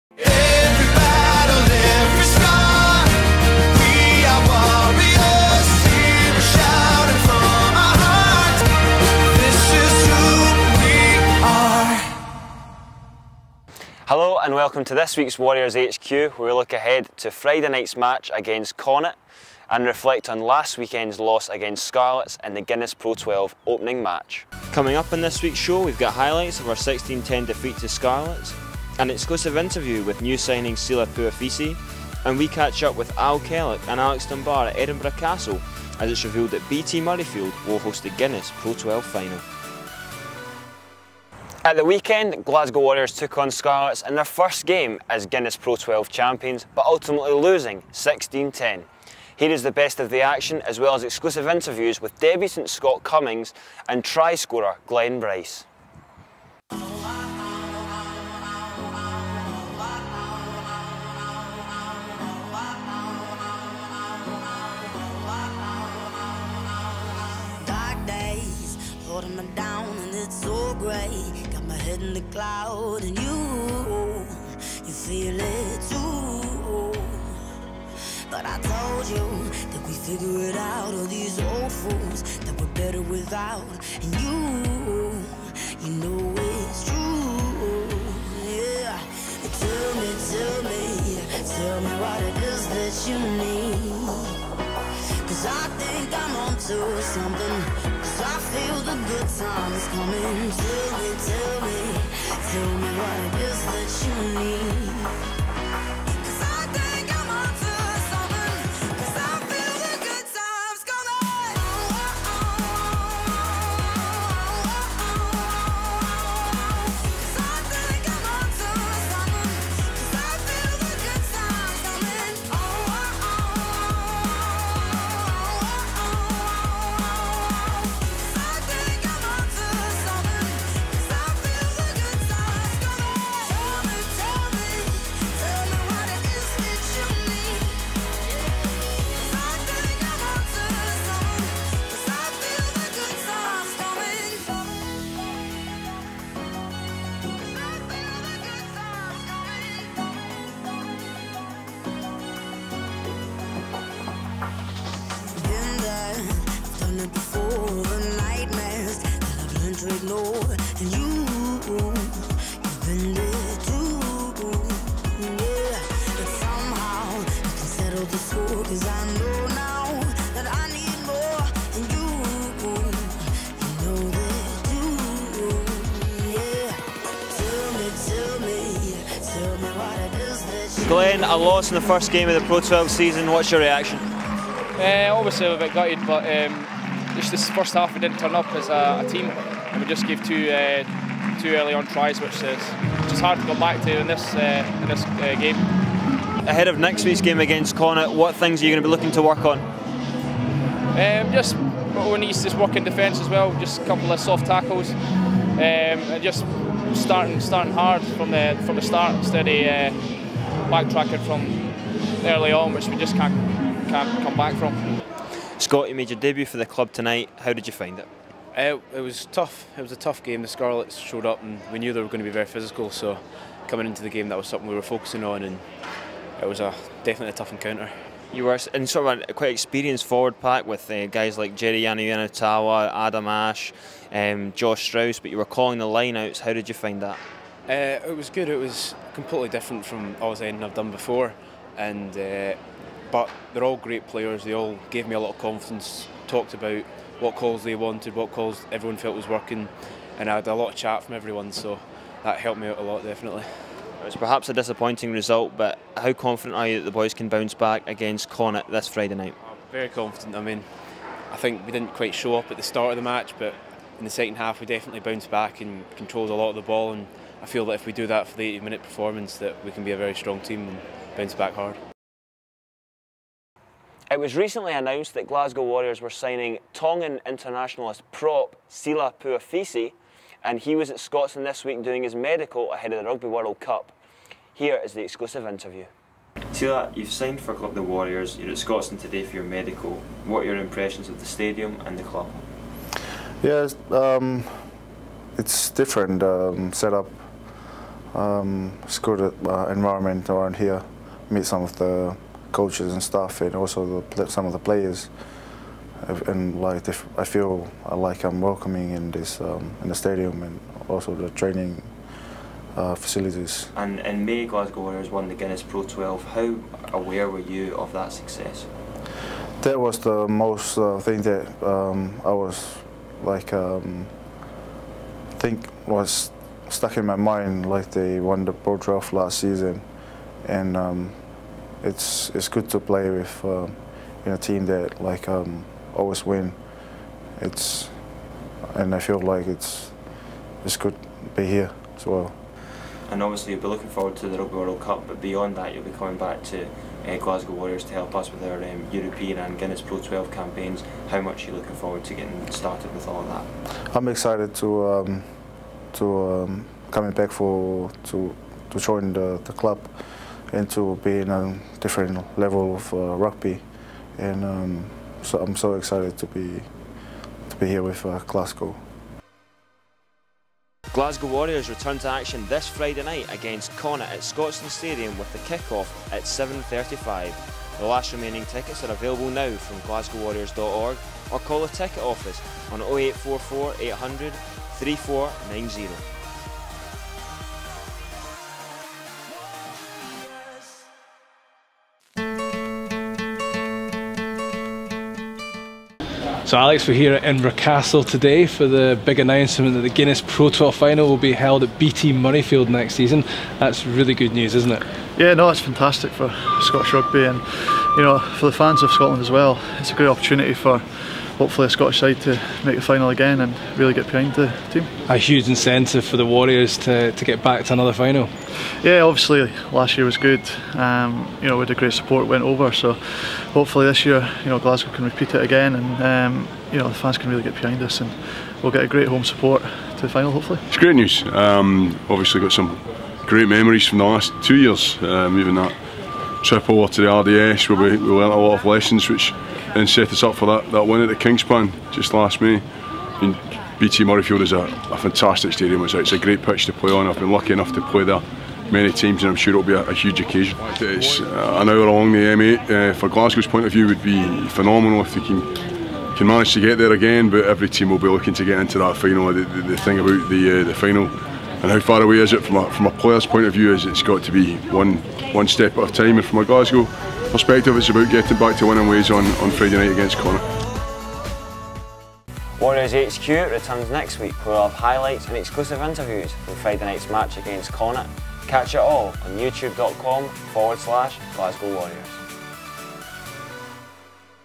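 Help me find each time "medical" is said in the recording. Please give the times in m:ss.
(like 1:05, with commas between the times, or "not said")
4:42, 4:49.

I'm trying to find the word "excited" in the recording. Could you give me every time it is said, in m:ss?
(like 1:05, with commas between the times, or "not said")
5:54, 6:05.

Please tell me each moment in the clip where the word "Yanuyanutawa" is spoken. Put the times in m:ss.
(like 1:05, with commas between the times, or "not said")
3:51.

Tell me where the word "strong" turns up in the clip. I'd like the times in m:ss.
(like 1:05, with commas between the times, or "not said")
4:30.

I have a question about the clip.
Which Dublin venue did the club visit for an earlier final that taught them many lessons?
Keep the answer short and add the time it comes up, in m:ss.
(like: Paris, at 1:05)
The RDS, at 7:17.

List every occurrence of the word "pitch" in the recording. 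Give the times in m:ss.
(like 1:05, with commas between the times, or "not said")
7:26.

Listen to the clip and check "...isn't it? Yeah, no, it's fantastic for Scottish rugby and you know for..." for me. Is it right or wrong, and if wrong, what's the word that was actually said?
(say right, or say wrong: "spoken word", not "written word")
right.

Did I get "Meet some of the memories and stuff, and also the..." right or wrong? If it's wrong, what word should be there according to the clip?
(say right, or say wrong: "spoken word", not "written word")
wrong: "coaches", not "memories".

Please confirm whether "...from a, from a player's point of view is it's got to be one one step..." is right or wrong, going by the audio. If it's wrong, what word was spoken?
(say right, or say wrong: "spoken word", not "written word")
right.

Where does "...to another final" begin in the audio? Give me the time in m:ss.
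6:57.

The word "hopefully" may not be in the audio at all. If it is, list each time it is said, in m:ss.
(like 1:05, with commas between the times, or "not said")
6:51, 7:03, 7:10.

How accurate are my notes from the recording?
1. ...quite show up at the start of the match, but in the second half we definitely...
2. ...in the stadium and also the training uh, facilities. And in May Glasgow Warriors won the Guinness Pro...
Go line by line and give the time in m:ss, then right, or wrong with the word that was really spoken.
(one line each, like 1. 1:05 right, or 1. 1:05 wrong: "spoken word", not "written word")
1. 4:21 right
2. 5:09 right.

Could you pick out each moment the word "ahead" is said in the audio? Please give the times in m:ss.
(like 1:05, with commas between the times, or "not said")
0:16, 3:16, 4:42.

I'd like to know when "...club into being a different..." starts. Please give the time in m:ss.
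5:59.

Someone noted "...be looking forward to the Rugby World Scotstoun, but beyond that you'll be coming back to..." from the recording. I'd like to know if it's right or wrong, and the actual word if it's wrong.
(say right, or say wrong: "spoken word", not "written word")
wrong: "Cup", not "Scotstoun".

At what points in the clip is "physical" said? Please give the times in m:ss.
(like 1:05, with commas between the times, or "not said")
3:42.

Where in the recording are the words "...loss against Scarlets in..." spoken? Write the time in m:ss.
0:21.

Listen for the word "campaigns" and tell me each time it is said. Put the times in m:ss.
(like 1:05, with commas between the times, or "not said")
5:50.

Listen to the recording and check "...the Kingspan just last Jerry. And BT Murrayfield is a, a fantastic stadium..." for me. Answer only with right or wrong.
wrong.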